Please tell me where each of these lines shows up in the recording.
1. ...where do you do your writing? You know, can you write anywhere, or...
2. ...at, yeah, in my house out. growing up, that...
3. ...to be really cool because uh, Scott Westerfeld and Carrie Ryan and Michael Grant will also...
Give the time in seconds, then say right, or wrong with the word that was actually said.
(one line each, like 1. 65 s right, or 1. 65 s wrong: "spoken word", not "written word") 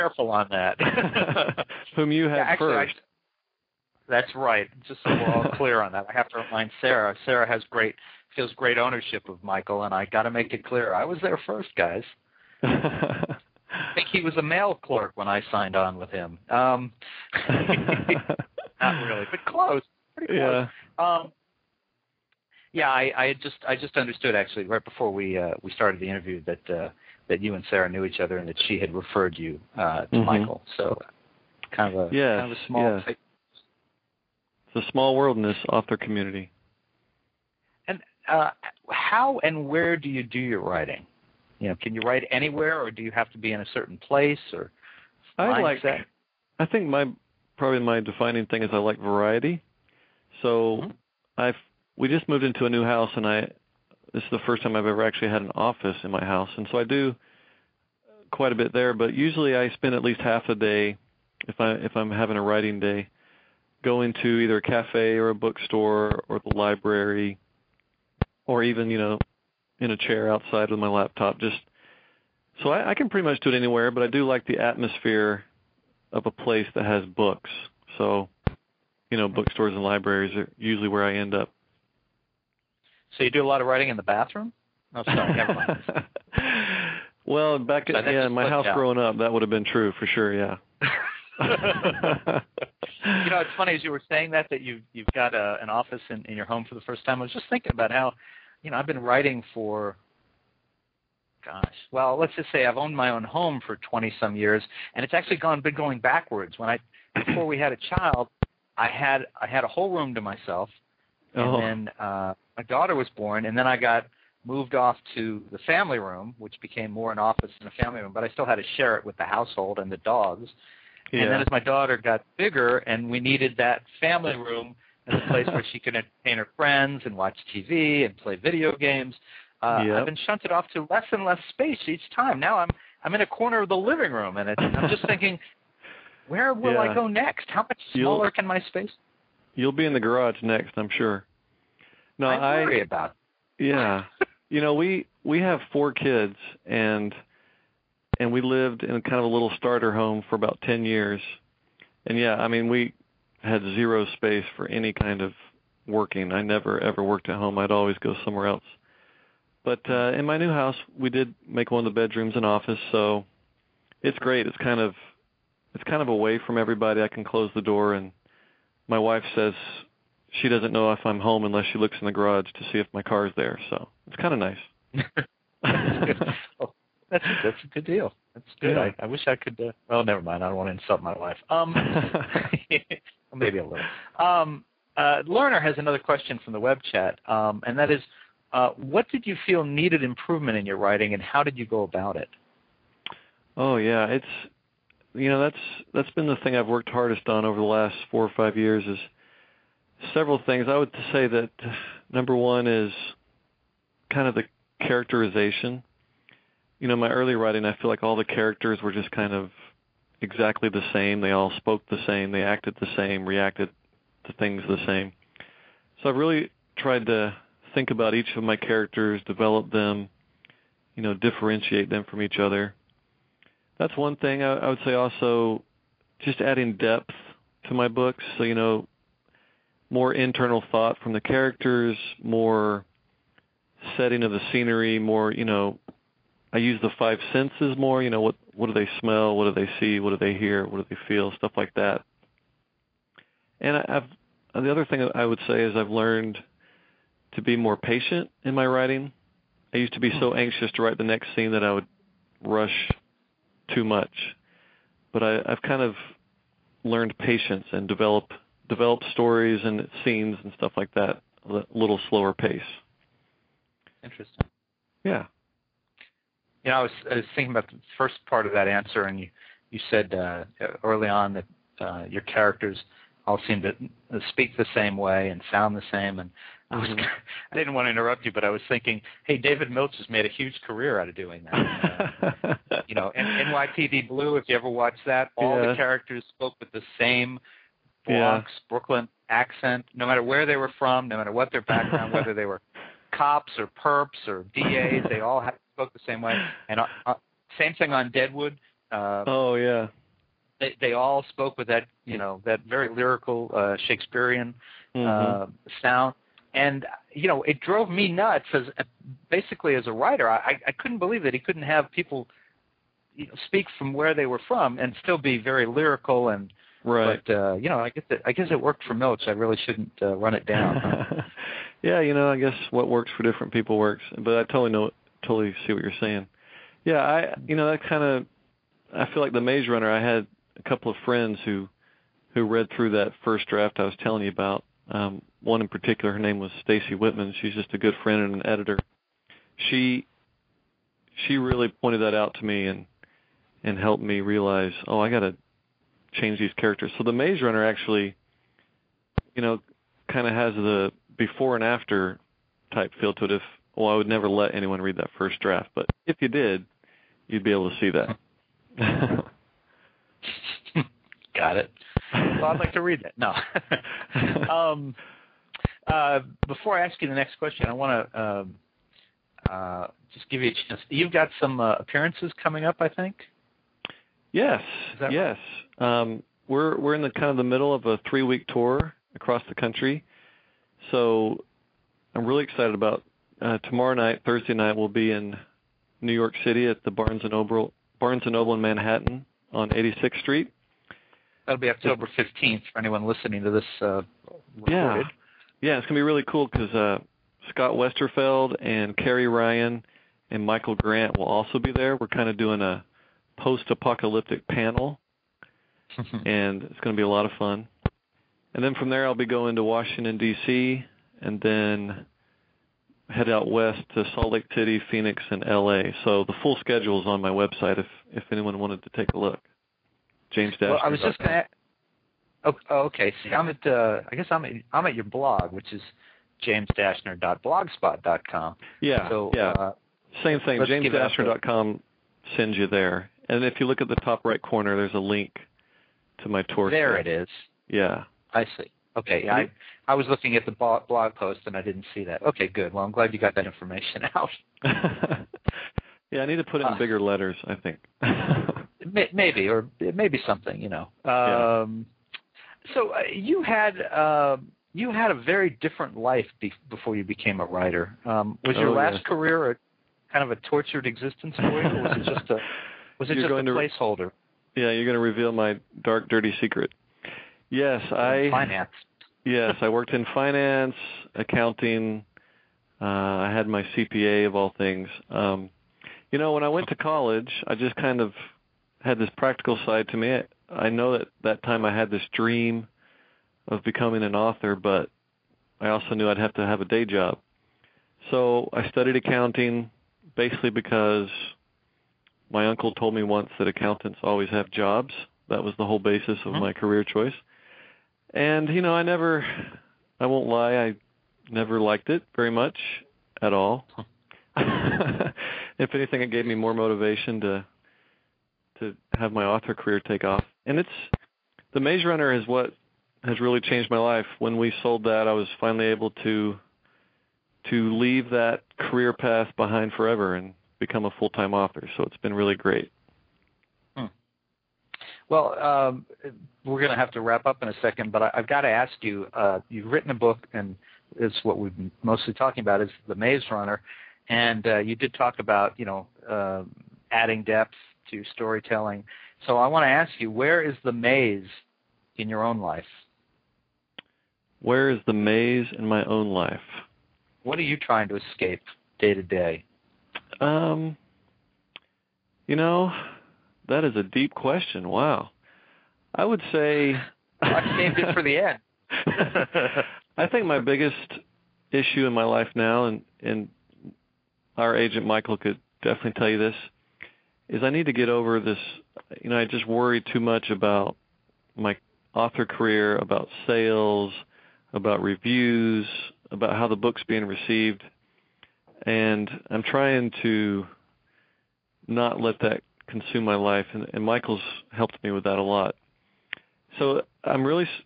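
1. 39 s right
2. 87 s right
3. 395 s right.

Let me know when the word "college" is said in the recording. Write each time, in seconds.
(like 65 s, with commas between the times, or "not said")
476 s.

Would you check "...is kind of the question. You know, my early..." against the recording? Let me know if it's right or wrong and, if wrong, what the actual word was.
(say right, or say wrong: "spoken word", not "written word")
wrong: "characterization", not "question".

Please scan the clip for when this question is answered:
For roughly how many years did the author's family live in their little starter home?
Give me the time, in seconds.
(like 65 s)
150 s.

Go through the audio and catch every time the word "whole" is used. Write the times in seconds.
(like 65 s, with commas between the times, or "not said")
109 s, 495 s.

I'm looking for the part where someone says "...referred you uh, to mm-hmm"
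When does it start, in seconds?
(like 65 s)
28 s.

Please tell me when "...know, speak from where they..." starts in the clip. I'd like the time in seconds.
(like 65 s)
313 s.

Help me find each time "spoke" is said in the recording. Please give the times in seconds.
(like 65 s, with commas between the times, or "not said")
211 s, 286 s, 295 s, 301 s.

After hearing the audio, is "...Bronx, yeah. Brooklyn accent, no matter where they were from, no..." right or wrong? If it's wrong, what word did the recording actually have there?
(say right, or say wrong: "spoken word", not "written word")
right.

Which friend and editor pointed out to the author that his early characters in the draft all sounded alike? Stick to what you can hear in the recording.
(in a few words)
Stacy Whitman.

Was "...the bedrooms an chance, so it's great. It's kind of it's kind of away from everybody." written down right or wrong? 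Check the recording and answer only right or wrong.
wrong.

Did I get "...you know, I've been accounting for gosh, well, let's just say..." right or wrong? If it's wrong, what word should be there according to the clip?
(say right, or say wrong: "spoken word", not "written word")
wrong: "writing", not "accounting".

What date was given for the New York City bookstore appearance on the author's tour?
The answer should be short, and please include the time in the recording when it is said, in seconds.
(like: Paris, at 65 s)
October 15th, at 391 s.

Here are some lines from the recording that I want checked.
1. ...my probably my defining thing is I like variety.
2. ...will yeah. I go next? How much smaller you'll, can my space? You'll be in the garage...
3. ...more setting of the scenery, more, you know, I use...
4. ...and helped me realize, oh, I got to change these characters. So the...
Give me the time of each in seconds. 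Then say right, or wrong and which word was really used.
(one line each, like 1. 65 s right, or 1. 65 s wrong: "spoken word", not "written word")
1. 46 s right
2. 136 s right
3. 232 s right
4. 343 s right.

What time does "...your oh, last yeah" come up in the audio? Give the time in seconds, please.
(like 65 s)
458 s.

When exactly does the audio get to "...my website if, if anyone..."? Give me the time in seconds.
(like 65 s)
417 s.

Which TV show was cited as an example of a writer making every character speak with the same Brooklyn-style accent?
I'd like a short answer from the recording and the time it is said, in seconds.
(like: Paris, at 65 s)
NYPD Blue, at 283 s.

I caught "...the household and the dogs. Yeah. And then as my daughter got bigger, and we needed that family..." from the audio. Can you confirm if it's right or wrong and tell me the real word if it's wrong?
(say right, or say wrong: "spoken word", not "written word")
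right.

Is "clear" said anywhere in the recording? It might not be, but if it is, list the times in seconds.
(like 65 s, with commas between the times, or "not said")
5 s, 10 s.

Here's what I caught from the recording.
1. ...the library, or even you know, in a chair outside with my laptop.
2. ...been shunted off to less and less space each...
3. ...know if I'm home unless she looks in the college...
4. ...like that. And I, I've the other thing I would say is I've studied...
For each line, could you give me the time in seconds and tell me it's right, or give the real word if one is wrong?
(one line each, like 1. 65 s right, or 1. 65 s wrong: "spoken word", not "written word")
1. 66 s right
2. 130 s right
3. 170 s wrong: "garage", not "college"
4. 241 s wrong: "learned", not "studied".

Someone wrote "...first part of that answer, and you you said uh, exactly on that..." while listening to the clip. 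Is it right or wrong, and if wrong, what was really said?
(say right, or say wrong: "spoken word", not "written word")
wrong: "early", not "exactly".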